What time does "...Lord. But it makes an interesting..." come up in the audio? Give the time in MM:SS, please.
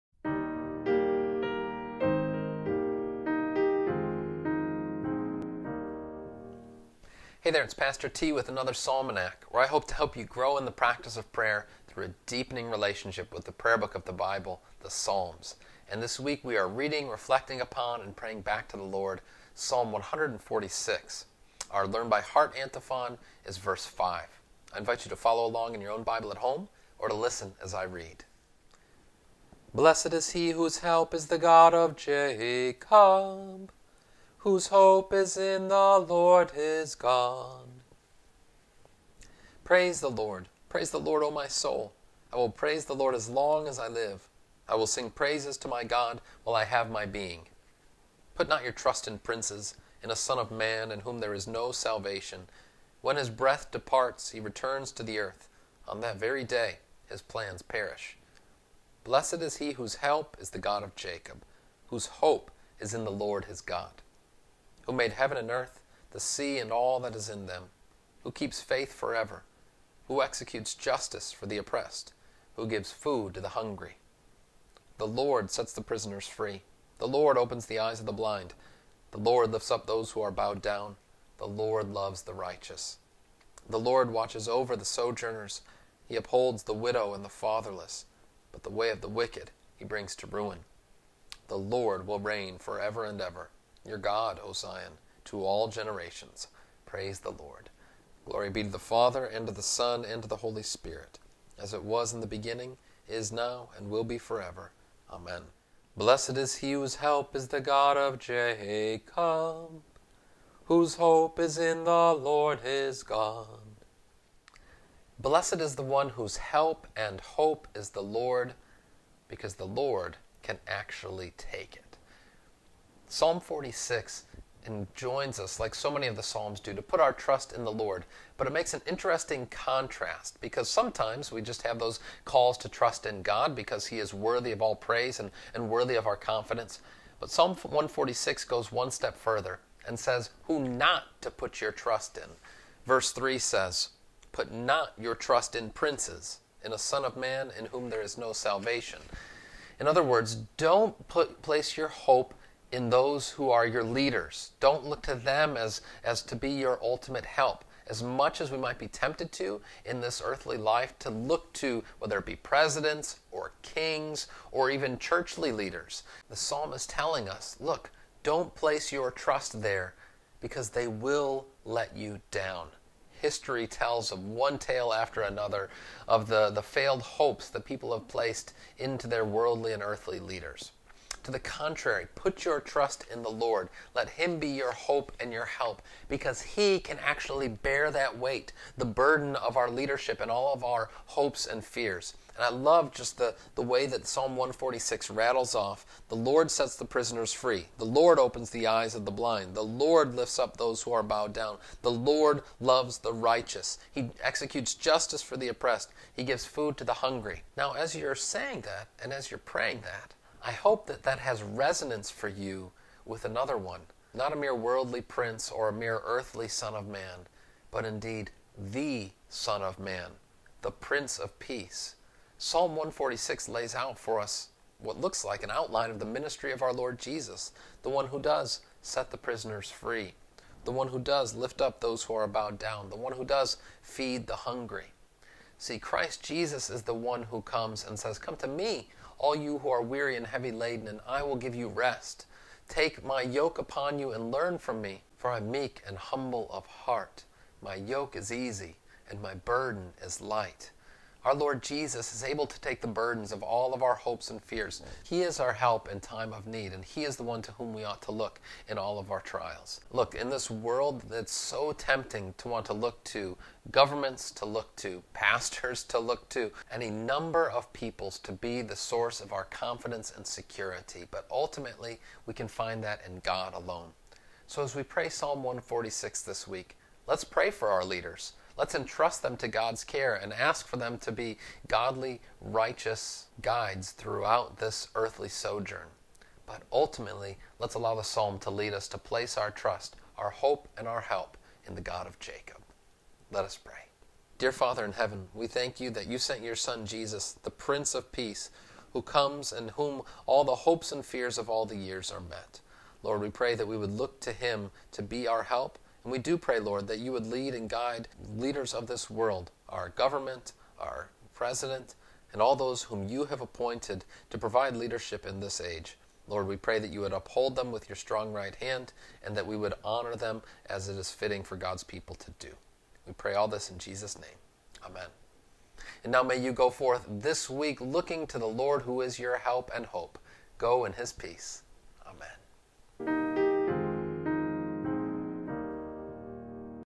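02:07.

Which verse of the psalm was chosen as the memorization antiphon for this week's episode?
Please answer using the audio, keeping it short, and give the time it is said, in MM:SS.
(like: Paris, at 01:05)
Verse 5, at 00:23.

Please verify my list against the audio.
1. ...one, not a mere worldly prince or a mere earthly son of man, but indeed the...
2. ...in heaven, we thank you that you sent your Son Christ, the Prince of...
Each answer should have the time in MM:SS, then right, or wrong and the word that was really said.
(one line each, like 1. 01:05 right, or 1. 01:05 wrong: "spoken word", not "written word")
1. 03:33 right
2. 04:54 wrong: "Jesus", not "Christ".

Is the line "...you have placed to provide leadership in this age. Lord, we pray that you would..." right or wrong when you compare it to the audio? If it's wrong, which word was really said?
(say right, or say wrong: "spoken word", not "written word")
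wrong: "appointed", not "placed".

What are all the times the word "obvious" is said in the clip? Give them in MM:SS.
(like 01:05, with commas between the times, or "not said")
not said.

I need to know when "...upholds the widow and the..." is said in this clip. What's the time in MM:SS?
01:26.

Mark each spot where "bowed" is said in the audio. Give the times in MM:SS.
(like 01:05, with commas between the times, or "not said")
01:20, 03:21, 03:52.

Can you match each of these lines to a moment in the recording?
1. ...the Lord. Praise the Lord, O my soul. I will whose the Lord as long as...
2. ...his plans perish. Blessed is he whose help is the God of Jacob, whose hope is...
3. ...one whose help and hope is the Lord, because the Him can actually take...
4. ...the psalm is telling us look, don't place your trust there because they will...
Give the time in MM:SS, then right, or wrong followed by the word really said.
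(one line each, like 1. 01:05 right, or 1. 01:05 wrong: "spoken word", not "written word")
1. 00:39 wrong: "praise", not "whose"
2. 00:57 right
3. 01:55 wrong: "Lord", not "Him"
4. 02:46 right.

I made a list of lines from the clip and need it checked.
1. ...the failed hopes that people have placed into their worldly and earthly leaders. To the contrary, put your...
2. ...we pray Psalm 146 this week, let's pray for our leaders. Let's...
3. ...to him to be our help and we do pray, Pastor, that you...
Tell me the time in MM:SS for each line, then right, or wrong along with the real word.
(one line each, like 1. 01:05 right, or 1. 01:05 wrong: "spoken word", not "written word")
1. 02:56 right
2. 04:34 right
3. 05:04 wrong: "Lord", not "Pastor".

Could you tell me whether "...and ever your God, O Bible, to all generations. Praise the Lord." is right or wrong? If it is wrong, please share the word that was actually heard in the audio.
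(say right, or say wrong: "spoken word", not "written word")
wrong: "Zion", not "Bible".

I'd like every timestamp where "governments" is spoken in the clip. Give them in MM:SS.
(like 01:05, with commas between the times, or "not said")
04:23, 05:09.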